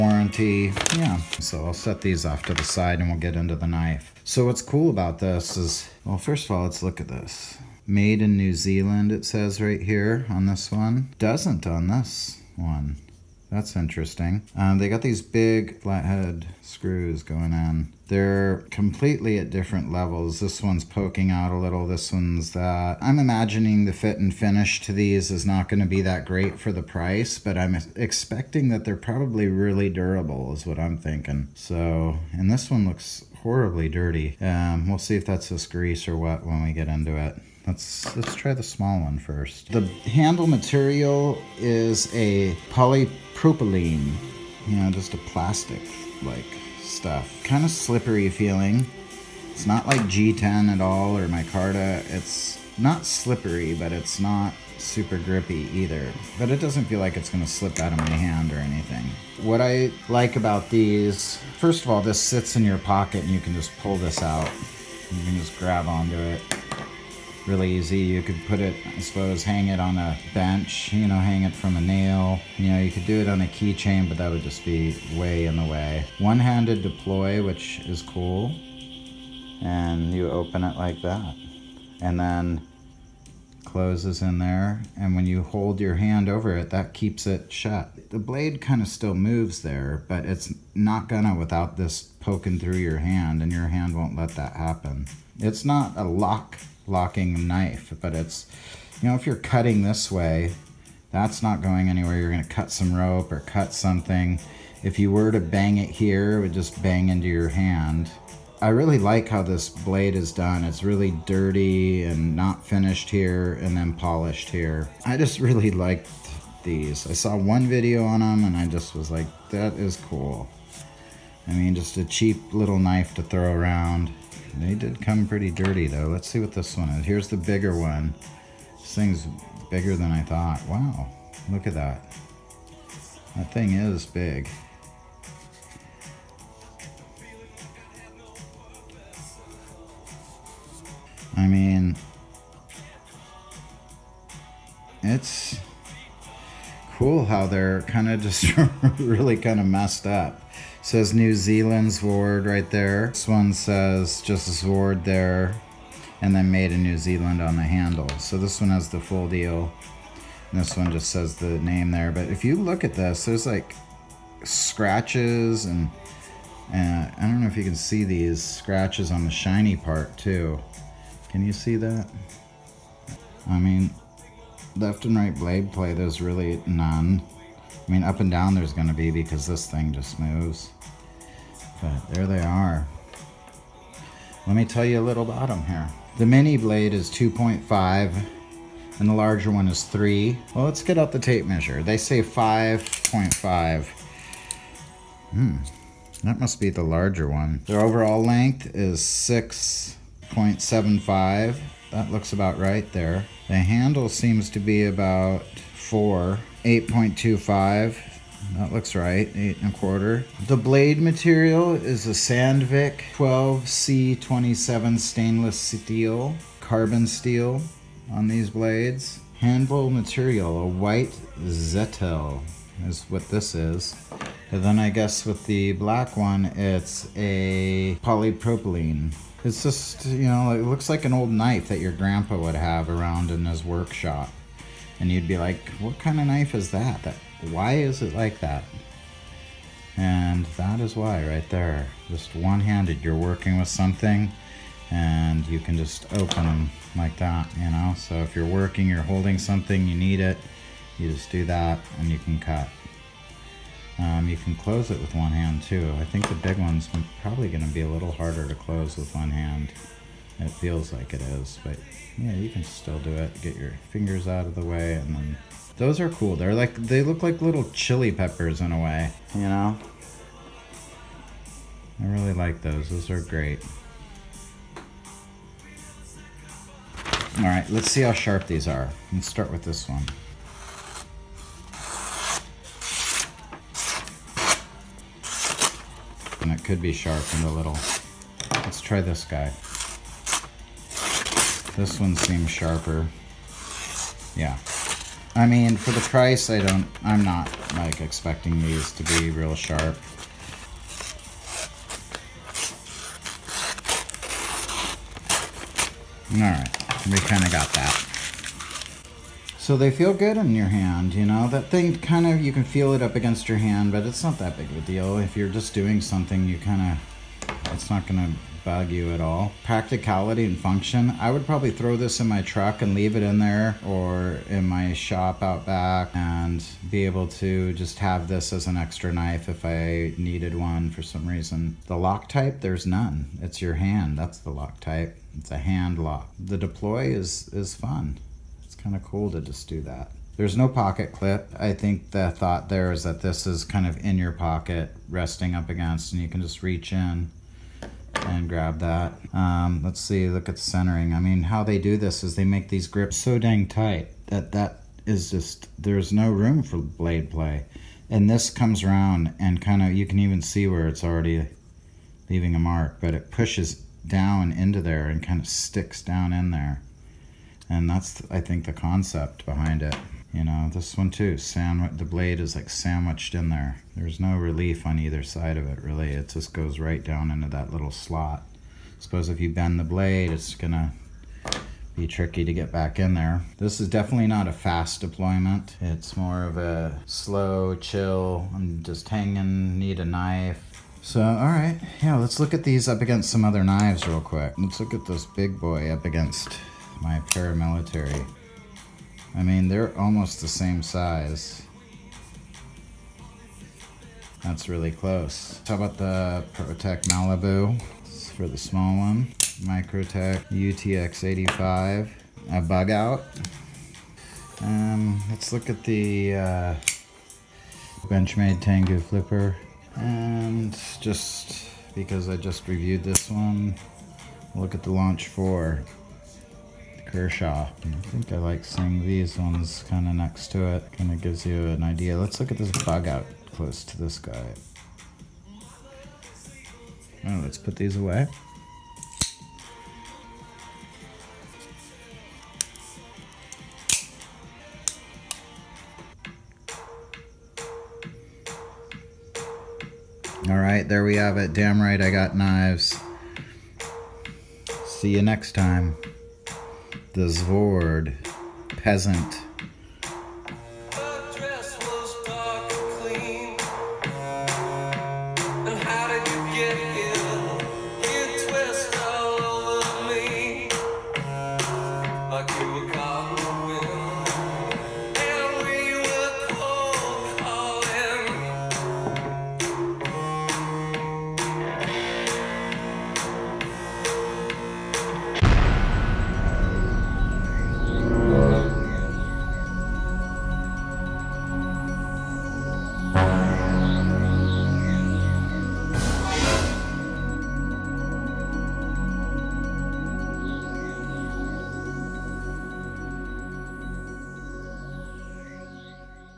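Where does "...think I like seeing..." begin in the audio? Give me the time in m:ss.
7:08.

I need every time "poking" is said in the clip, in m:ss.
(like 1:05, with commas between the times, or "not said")
0:20, 1:32.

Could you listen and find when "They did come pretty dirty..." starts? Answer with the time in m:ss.
2:04.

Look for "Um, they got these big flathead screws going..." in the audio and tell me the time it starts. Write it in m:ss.
0:14.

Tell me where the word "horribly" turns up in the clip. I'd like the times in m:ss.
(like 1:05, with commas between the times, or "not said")
0:33.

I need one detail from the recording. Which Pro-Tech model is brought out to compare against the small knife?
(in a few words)
Malibu.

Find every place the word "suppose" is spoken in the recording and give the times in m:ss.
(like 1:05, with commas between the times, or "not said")
1:08, 6:18.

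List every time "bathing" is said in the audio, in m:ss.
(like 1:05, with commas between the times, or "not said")
not said.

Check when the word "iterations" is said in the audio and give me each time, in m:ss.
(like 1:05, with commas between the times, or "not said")
not said.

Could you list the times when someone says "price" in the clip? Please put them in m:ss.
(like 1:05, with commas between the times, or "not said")
0:26, 4:55.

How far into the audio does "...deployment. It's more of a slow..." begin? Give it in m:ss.
6:25.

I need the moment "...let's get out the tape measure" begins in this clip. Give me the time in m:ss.
3:10.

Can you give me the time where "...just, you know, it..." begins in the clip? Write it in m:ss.
3:49.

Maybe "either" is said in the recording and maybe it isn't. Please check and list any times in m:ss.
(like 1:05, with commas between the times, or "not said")
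0:55, 6:14.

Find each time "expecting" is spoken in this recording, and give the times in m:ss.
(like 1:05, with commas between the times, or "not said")
0:27, 4:58.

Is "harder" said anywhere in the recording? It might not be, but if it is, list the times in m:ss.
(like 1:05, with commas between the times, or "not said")
4:18.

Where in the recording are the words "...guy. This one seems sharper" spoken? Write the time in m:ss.
4:49.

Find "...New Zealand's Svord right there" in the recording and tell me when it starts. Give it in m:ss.
2:31.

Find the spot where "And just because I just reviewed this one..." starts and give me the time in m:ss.
6:59.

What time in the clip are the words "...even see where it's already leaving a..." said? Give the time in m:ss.
6:00.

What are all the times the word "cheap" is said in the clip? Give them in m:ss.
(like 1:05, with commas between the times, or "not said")
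2:02.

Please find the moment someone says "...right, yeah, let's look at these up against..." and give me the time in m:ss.
6:31.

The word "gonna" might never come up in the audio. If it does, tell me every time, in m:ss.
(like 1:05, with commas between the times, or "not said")
0:57, 1:31, 1:42, 4:17, 6:20.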